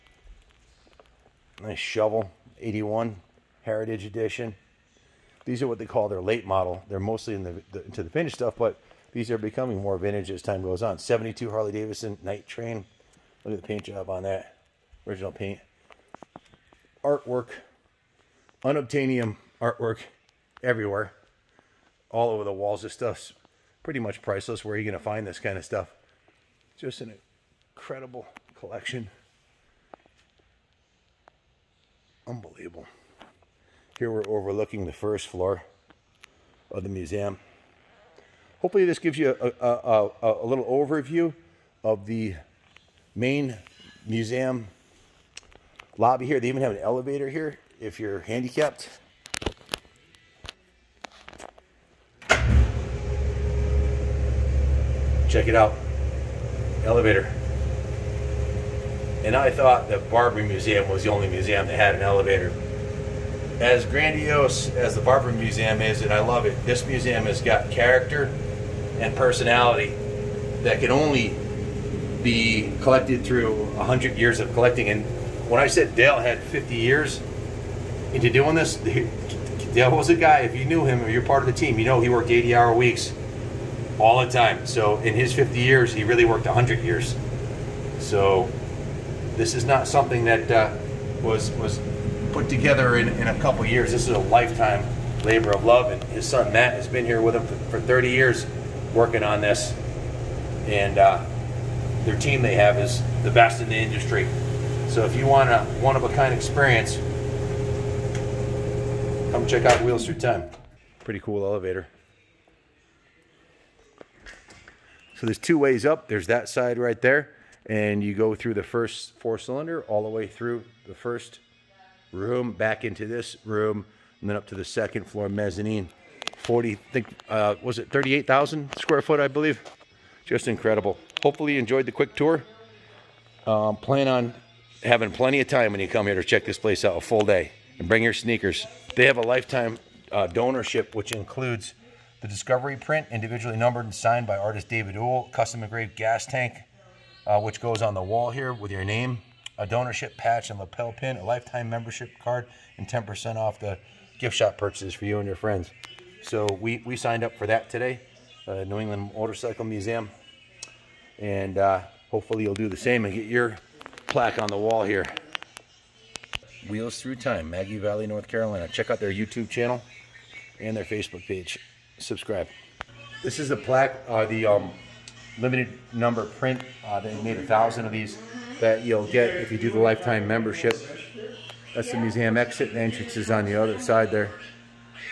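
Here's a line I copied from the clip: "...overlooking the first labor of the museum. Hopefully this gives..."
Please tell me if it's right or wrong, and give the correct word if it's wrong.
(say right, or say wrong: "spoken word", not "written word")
wrong: "floor", not "labor".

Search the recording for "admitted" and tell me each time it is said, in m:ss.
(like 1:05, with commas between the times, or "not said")
not said.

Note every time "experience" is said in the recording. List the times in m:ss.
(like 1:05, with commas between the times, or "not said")
1:46.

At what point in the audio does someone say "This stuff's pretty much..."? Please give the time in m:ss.
0:22.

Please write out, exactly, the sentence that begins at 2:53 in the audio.
This is the plaque, uh, the um, limited number print.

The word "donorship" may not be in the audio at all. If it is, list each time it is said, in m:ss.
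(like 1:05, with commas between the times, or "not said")
2:20, 2:29.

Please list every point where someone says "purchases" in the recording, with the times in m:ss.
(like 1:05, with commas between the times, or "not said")
2:34.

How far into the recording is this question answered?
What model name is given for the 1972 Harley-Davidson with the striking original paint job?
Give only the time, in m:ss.
0:12.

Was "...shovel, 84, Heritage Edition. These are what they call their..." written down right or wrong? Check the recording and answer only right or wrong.
wrong.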